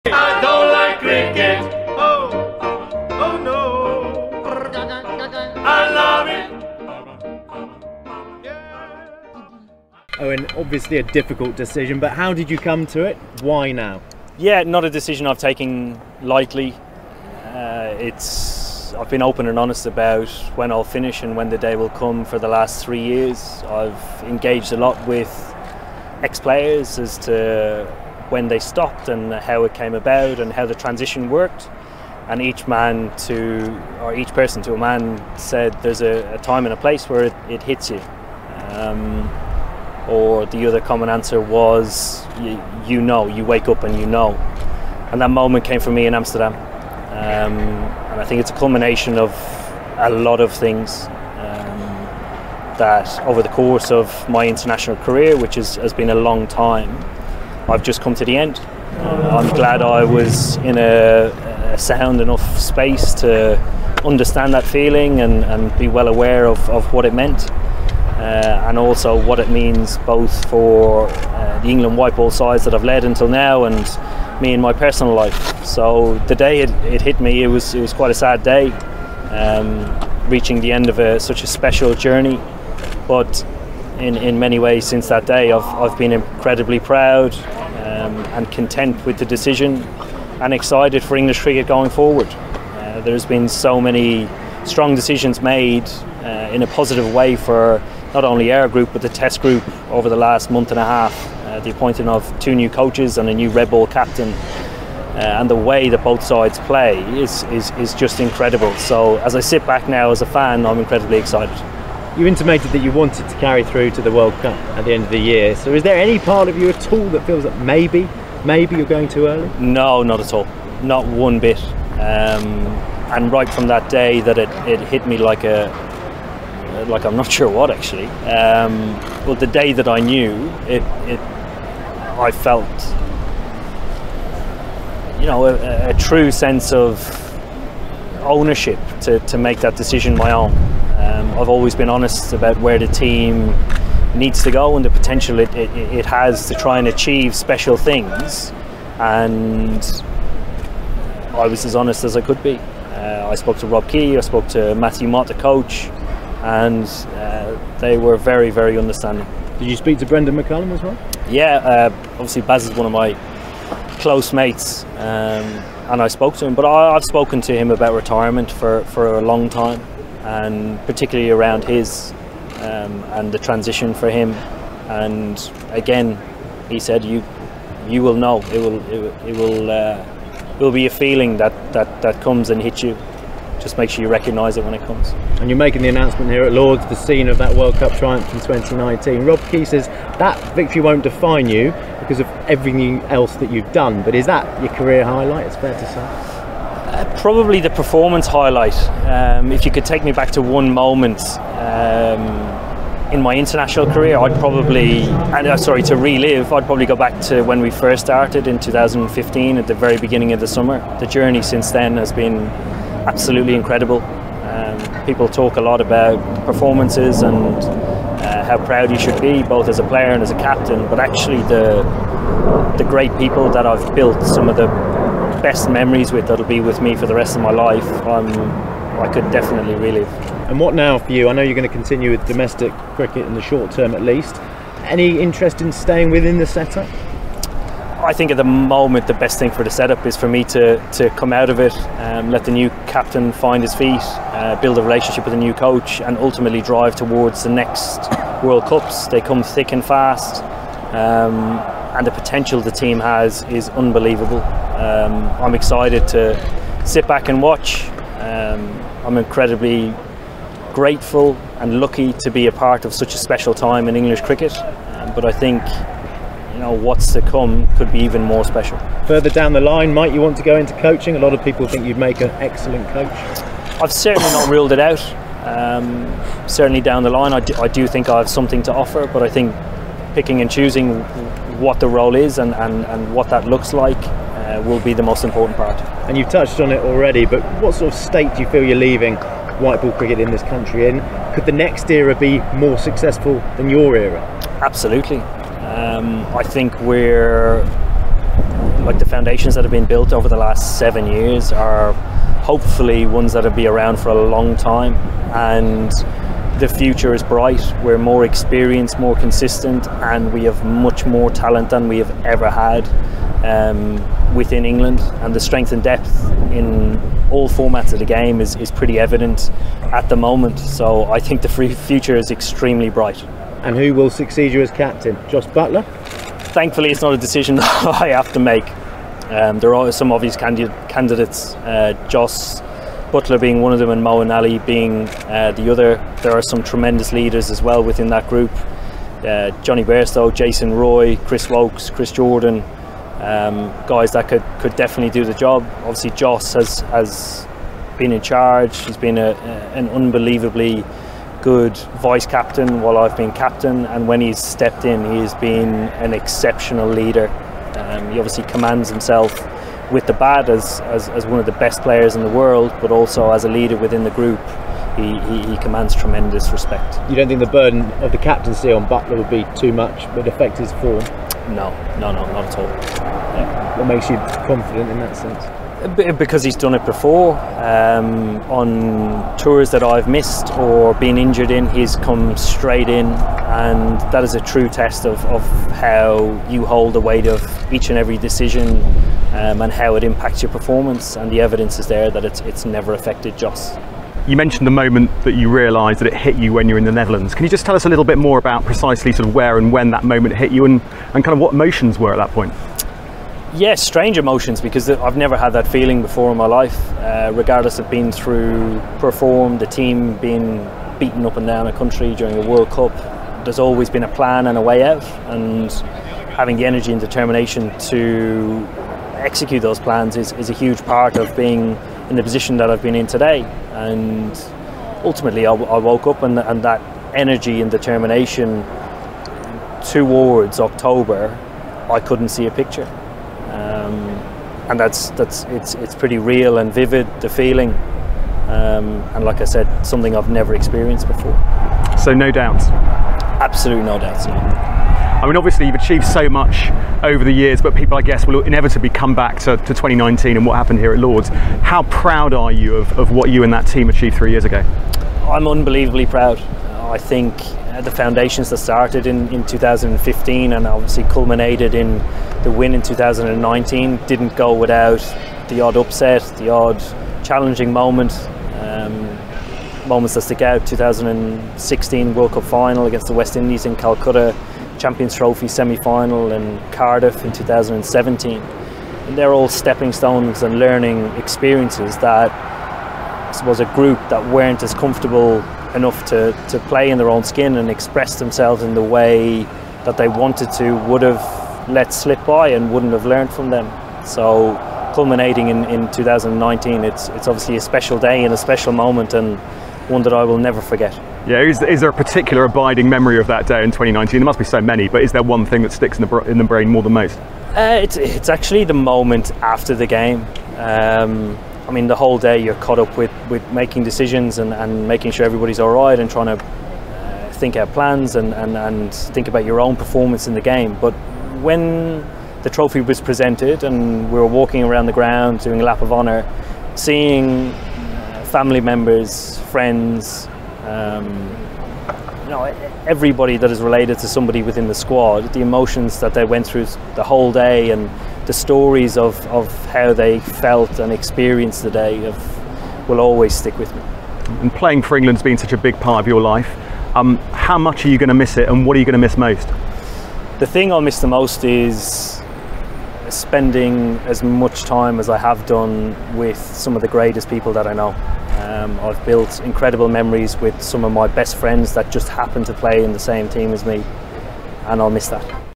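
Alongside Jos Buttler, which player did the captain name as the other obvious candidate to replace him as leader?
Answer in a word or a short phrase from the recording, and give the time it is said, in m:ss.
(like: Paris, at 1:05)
Mo Ali, at 5:34.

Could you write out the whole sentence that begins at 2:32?
Uh, I spoke to Rob Key, I spoke to Matthew Mott, the coach and uh, they were very, very understanding.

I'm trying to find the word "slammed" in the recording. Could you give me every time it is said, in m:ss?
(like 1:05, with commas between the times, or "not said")
not said.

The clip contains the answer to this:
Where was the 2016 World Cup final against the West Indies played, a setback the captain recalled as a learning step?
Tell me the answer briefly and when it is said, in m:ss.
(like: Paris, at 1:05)
Calcutta, at 7:53.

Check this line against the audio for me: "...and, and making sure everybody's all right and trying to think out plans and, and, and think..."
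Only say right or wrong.
right.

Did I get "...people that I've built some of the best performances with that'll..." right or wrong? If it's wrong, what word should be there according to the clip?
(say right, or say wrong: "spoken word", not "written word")
wrong: "memories", not "performances".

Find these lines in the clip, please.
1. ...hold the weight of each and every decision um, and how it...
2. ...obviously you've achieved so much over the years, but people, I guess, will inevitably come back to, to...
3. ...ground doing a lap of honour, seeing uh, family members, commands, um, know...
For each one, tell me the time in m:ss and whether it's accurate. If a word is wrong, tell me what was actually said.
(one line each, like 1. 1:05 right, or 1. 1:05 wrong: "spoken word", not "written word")
1. 6:26 right
2. 7:25 right
3. 8:44 wrong: "friends", not "commands".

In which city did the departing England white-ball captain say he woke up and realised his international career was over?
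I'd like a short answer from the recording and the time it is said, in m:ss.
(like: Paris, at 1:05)
Amsterdam, at 0:46.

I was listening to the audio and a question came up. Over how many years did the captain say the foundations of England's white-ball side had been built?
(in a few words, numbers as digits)
7.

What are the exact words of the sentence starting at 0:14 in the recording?
Yeah, not a decision I've taken lightly.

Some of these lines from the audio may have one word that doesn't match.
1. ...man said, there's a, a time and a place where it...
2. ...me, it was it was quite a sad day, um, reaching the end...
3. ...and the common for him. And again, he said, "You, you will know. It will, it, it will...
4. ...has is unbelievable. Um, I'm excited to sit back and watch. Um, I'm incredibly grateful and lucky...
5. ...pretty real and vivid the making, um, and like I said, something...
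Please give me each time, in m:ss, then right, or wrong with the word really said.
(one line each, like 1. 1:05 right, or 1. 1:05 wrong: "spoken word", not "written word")
1. 0:34 right
2. 1:17 right
3. 2:53 wrong: "transition", not "common"
4. 4:12 right
5. 7:15 wrong: "feeling", not "making".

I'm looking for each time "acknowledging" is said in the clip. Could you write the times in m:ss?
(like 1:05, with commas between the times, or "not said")
not said.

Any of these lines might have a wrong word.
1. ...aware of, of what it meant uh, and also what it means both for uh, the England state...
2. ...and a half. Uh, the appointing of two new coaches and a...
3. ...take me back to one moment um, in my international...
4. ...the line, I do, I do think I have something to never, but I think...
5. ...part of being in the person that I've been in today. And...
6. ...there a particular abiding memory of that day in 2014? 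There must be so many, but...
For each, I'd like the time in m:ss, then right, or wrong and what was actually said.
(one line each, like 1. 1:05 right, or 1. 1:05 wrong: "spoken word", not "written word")
1. 1:06 wrong: "white", not "state"
2. 1:40 right
3. 3:19 right
4. 4:37 wrong: "offer", not "never"
5. 7:00 wrong: "position", not "person"
6. 8:21 wrong: "2019", not "2014".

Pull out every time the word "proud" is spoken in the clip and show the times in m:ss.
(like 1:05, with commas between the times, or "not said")
1:26, 3:38, 7:31, 7:36.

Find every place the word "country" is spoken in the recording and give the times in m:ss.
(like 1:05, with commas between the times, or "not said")
4:50, 6:51.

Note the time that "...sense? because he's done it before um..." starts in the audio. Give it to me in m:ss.
6:15.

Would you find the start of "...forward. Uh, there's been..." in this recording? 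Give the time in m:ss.
1:31.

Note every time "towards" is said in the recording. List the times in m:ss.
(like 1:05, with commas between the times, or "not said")
4:06, 7:09.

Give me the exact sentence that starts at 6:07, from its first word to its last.
You don't think the burden of the captaincy on Buttler would be too much, would affect his form?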